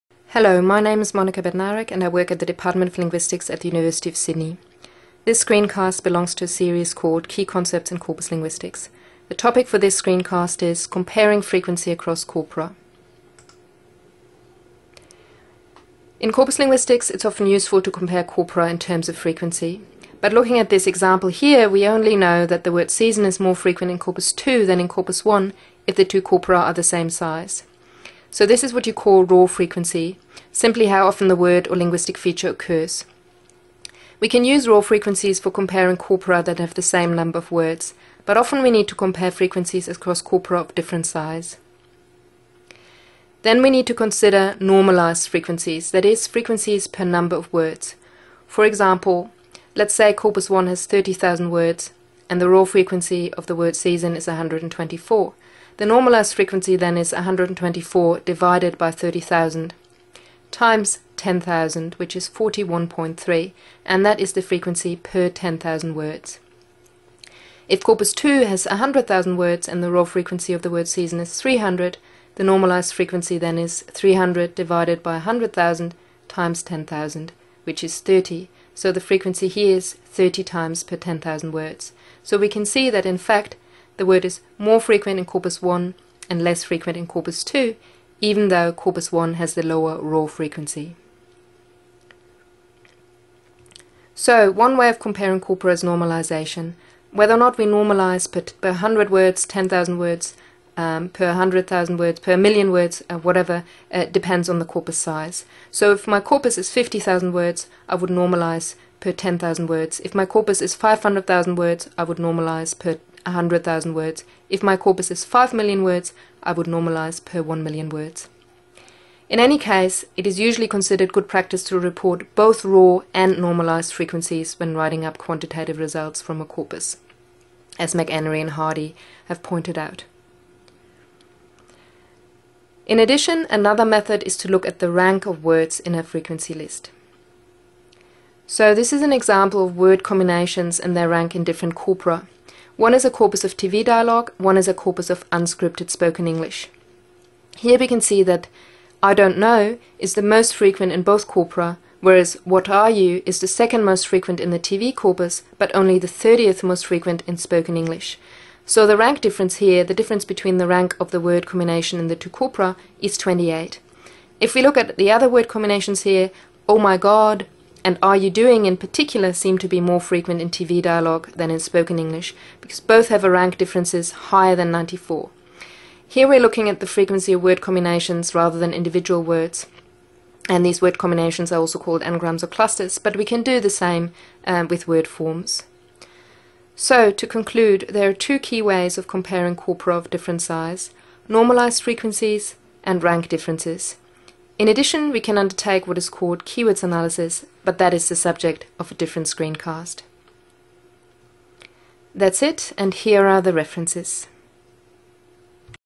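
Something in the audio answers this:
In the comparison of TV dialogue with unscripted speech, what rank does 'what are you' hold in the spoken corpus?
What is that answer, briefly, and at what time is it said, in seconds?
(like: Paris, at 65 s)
30th, at 156 s.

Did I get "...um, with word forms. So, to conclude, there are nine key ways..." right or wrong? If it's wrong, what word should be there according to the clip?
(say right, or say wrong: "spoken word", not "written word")
wrong: "two", not "nine".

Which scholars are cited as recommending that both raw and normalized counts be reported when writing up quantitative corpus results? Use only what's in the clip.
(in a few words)
McEnery and Hardie.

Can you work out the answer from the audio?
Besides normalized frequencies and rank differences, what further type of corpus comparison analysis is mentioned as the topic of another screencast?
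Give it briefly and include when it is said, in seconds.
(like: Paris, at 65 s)
keywords analysis, at 196 s.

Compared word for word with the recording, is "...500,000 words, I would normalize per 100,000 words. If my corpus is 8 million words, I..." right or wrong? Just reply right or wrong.
wrong.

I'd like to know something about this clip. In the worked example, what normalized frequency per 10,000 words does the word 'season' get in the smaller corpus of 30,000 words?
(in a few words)
41.3.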